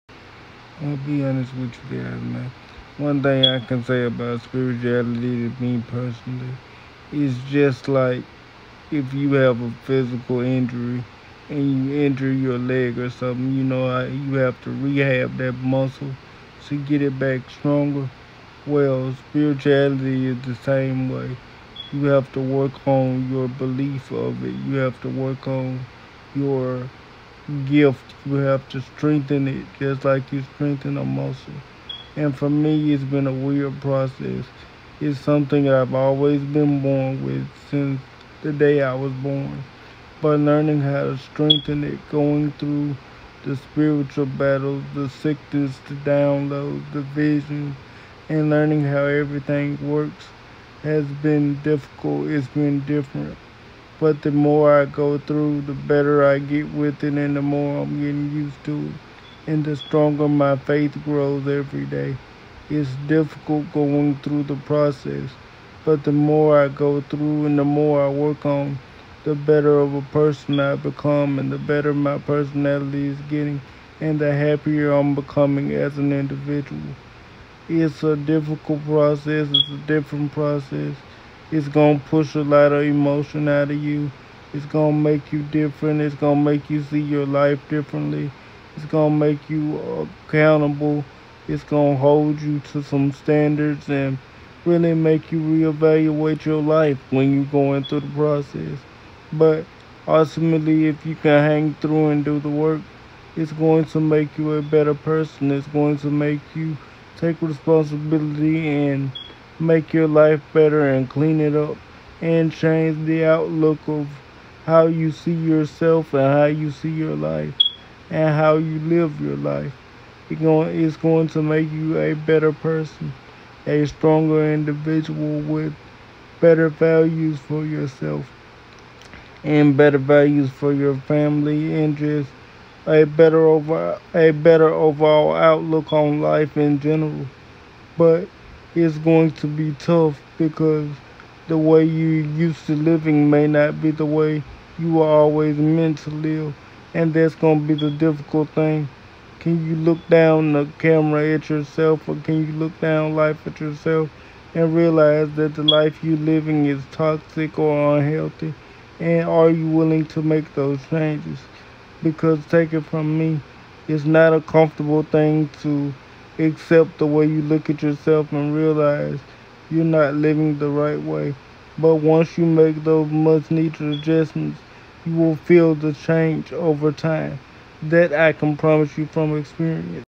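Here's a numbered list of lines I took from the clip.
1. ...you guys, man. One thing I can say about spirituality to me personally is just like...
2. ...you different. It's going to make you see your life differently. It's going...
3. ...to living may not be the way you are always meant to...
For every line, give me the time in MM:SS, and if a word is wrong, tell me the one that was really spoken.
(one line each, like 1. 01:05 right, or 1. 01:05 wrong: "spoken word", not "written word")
1. 00:01 right
2. 01:25 right
3. 02:22 right.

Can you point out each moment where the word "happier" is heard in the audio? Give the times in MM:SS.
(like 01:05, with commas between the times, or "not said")
01:14.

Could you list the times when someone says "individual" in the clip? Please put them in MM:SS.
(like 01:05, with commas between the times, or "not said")
01:16, 02:04.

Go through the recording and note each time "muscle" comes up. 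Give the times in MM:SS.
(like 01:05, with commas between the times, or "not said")
00:15, 00:31.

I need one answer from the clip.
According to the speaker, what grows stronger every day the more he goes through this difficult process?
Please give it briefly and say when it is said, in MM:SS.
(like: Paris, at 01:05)
faith, at 01:00.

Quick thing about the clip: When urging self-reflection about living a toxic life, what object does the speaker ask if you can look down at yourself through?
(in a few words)
camera.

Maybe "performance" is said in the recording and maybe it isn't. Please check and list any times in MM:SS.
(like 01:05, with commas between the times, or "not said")
not said.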